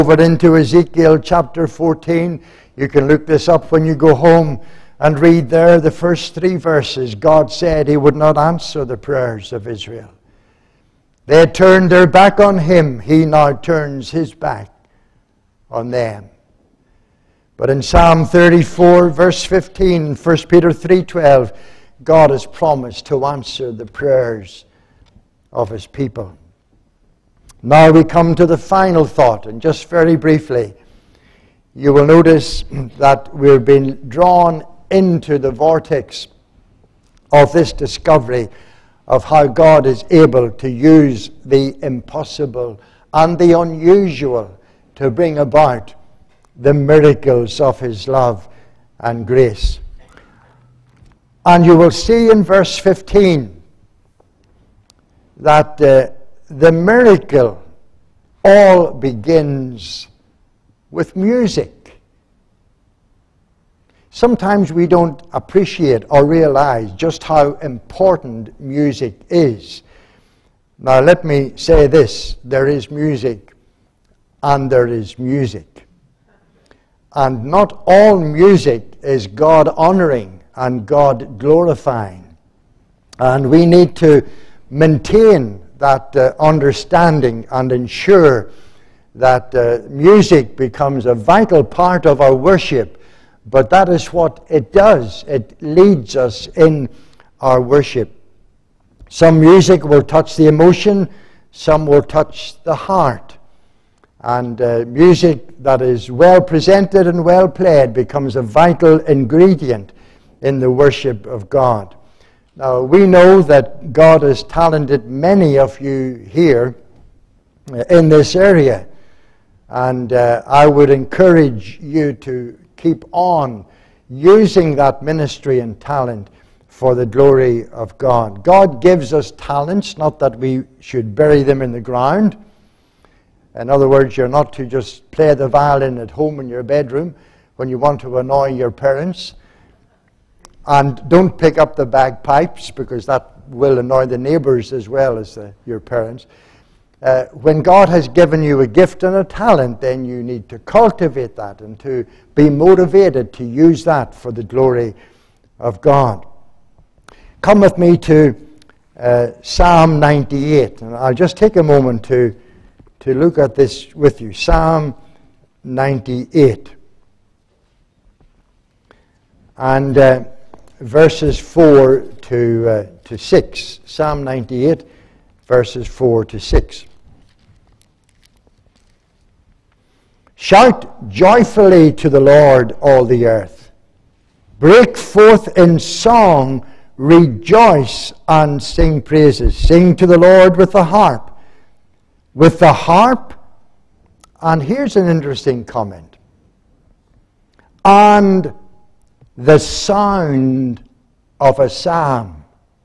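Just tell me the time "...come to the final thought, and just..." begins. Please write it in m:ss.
0:28.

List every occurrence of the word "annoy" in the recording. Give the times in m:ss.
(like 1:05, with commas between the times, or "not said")
2:18, 2:23.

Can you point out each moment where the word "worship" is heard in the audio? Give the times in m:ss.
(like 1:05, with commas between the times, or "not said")
1:32, 1:37, 1:50.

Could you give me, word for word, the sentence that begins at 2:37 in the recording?
Come with me to uh, Psalm 98, and I'll just take a moment to, to look at this with you.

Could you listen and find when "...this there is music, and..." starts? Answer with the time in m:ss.
1:11.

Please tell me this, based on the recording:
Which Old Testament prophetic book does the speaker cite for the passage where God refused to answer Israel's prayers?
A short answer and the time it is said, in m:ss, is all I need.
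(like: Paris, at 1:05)
Ezekiel, at 0:00.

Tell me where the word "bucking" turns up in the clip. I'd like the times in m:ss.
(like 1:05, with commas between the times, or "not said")
not said.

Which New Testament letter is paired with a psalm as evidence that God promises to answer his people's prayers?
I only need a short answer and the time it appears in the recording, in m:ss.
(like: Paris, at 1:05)
1 Peter, at 0:20.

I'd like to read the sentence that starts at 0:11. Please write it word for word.
They had turned their back on him.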